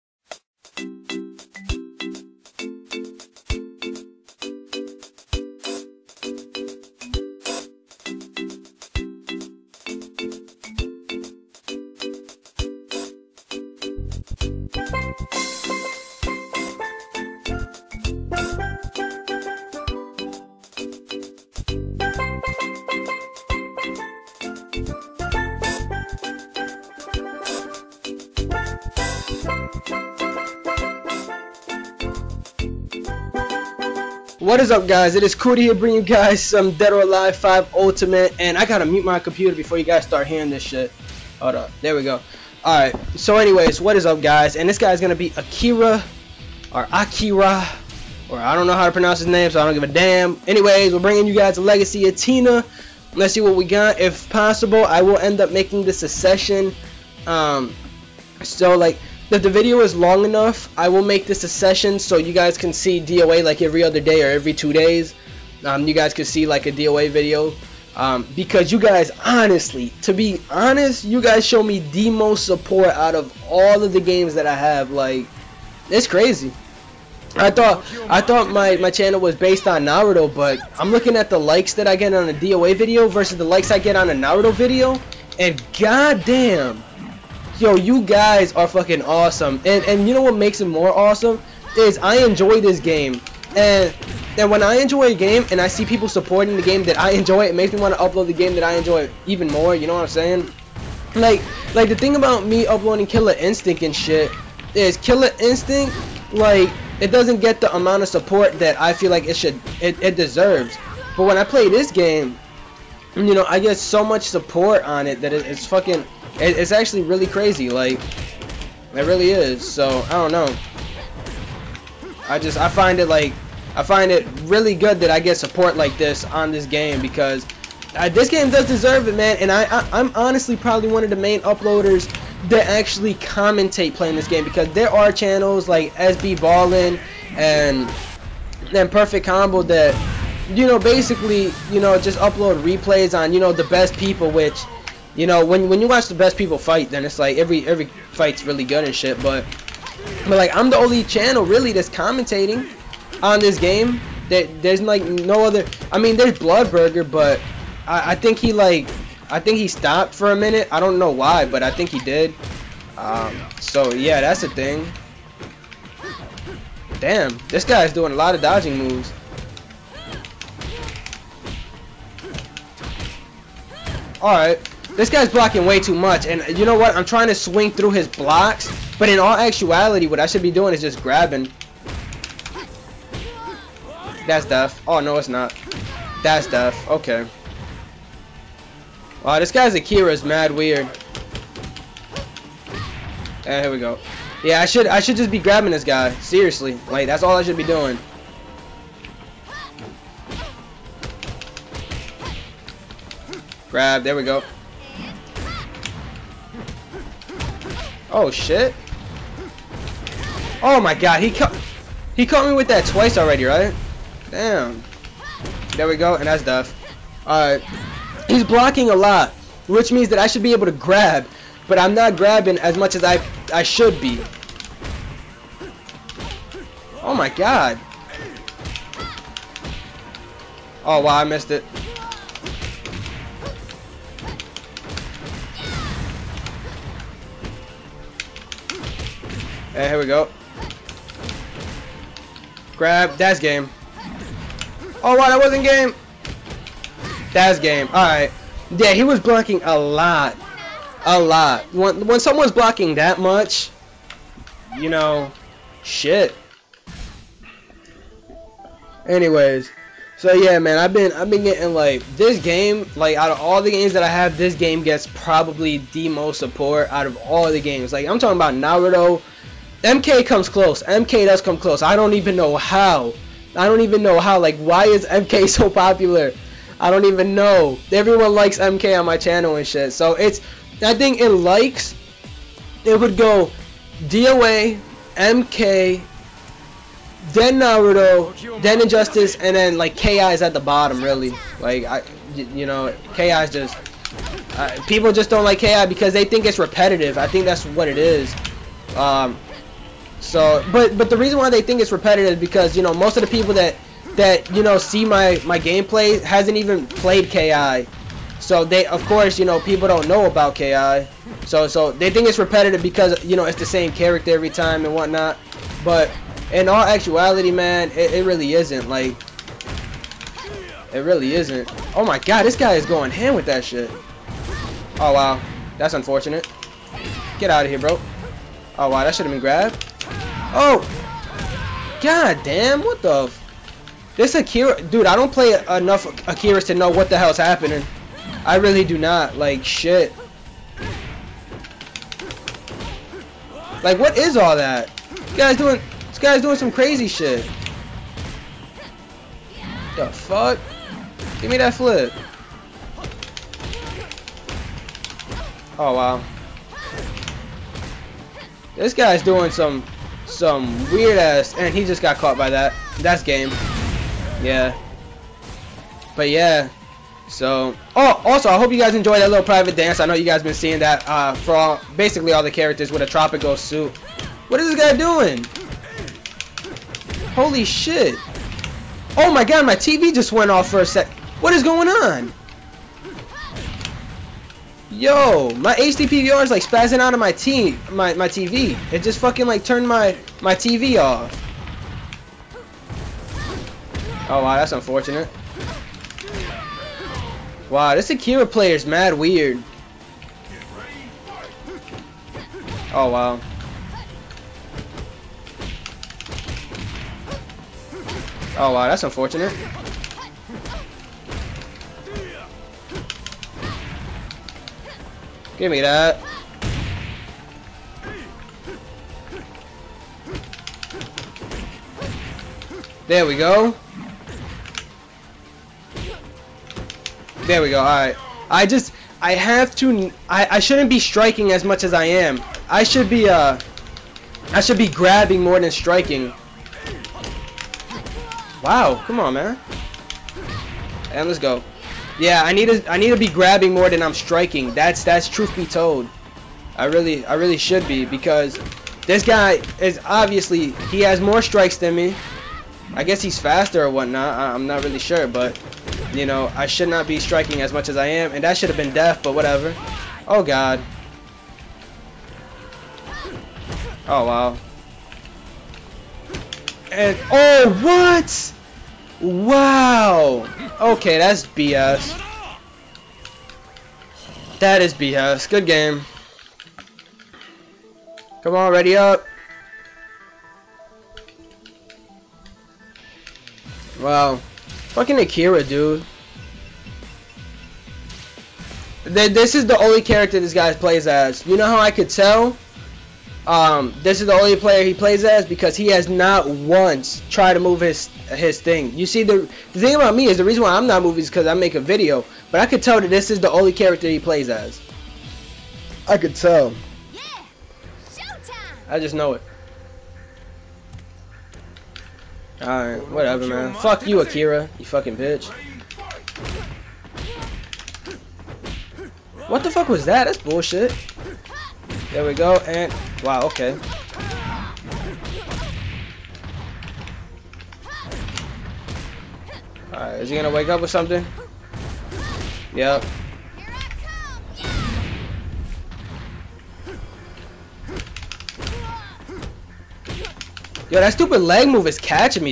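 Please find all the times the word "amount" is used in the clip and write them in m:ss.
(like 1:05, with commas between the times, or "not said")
1:47.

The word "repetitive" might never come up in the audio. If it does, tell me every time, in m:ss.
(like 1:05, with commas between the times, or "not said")
4:56, 5:01, 5:12.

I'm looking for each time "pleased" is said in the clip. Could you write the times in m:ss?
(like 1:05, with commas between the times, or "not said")
not said.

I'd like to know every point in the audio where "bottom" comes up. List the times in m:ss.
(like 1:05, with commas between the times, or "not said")
4:50.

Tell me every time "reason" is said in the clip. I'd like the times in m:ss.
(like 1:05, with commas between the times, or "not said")
5:01, 8:20.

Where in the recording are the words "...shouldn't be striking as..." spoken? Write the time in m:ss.
7:10.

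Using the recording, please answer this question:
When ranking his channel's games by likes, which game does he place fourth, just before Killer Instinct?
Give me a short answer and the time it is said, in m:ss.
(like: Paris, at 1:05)
Injustice, at 4:48.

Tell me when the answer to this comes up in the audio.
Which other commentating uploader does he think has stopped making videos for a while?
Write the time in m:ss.
2:36.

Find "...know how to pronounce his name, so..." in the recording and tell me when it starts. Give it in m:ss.
0:48.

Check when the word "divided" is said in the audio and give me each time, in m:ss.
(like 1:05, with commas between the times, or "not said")
not said.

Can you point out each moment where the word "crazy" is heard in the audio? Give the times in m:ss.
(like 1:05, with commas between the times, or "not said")
1:16, 1:57, 5:46.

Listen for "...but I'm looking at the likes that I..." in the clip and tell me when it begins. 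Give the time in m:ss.
1:20.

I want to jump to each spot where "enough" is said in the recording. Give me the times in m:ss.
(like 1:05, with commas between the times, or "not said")
1:00, 5:35.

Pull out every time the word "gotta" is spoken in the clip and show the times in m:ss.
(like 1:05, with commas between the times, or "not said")
0:38.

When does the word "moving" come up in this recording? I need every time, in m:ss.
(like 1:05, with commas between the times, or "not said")
8:21.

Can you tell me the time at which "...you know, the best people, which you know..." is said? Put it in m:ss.
2:23.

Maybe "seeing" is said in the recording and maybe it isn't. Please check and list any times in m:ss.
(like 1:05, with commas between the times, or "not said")
6:10.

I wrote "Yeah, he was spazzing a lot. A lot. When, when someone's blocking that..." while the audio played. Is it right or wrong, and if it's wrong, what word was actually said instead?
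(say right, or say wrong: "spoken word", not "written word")
wrong: "blocking", not "spazzing".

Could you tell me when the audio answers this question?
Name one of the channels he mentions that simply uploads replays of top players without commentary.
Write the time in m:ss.
2:18.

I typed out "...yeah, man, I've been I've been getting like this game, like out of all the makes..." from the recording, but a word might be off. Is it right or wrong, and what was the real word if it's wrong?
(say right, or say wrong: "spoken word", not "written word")
wrong: "games", not "makes".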